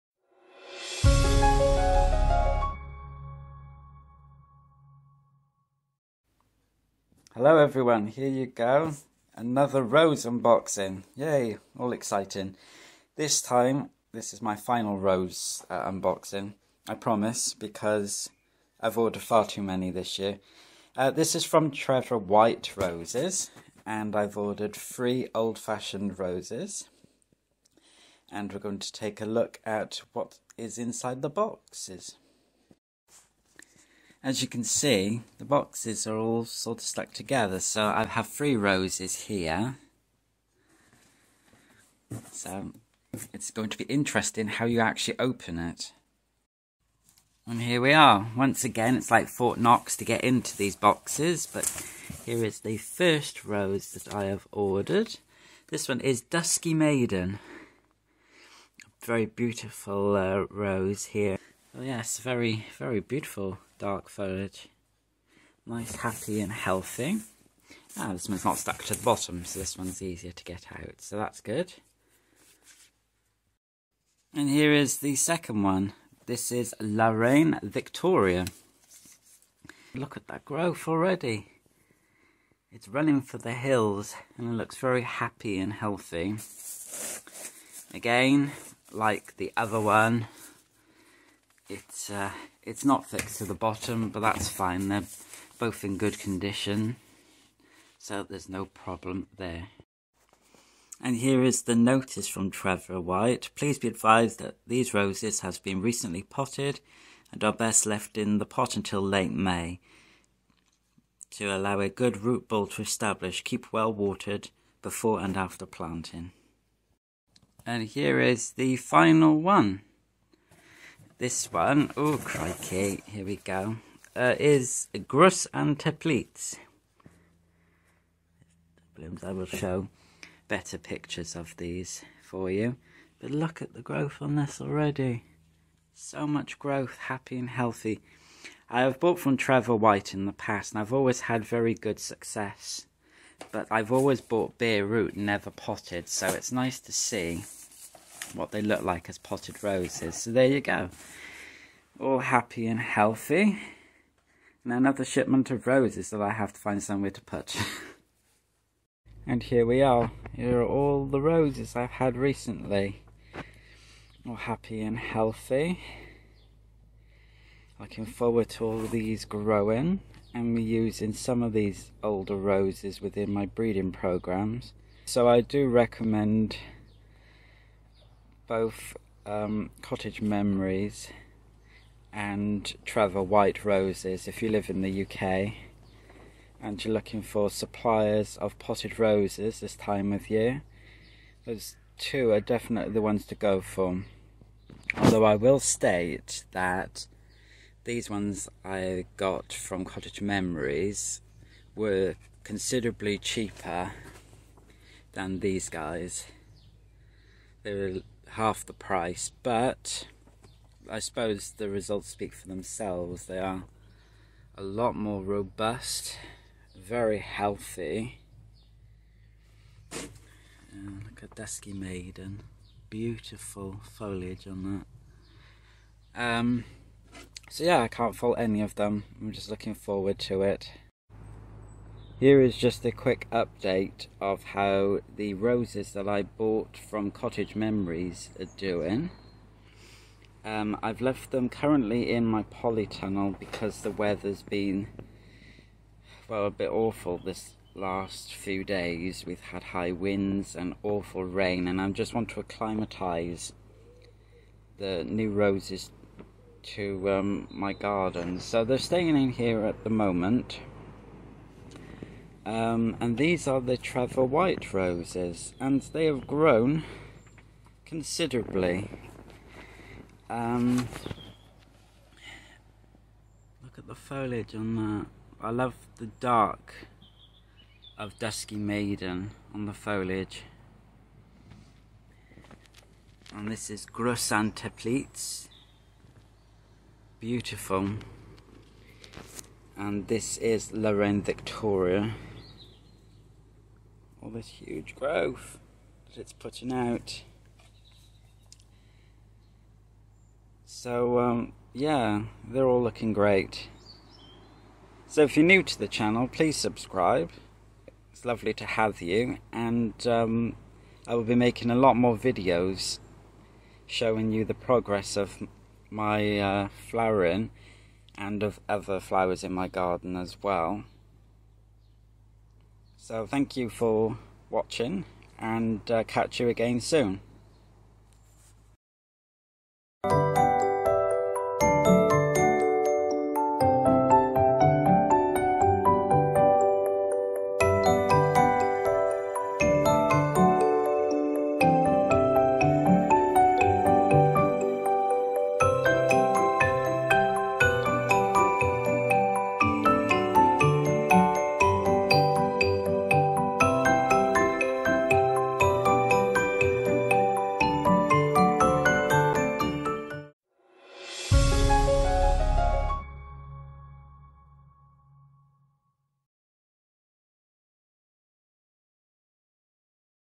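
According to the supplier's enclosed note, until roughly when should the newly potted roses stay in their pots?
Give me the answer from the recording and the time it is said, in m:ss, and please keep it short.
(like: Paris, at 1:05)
late May, at 1:49.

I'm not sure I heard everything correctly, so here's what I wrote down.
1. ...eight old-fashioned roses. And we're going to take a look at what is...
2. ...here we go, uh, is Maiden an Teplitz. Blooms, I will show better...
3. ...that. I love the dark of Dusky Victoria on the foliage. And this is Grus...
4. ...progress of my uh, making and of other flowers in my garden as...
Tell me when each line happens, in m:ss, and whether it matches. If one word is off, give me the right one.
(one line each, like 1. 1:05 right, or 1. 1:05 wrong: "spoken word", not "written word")
1. 0:24 wrong: "three", not "eight"
2. 2:03 wrong: "Gruss", not "Maiden"
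3. 4:34 wrong: "Maiden", not "Victoria"
4. 5:14 wrong: "flowering", not "making".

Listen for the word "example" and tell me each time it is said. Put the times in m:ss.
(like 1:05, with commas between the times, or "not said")
not said.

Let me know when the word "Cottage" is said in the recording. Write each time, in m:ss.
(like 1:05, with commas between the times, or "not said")
2:59, 3:19, 3:57.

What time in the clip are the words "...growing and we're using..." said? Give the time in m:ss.
2:49.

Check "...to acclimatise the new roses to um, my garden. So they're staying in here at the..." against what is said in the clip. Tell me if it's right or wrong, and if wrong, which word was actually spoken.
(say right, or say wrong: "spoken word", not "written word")
right.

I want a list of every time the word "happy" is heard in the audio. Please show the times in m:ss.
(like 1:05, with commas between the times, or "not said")
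1:05, 1:25, 2:16, 2:32, 2:44.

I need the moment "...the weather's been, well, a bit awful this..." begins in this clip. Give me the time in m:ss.
4:03.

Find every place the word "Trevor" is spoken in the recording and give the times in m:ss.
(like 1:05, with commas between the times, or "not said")
0:21, 1:42, 2:19, 3:02, 4:23.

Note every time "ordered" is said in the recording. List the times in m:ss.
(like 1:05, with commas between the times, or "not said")
0:18, 0:24, 0:54.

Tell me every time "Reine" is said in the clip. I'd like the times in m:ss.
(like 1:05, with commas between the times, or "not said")
1:17, 4:50.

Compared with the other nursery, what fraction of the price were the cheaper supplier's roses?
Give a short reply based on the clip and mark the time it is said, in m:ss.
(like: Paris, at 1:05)
half the price, at 3:28.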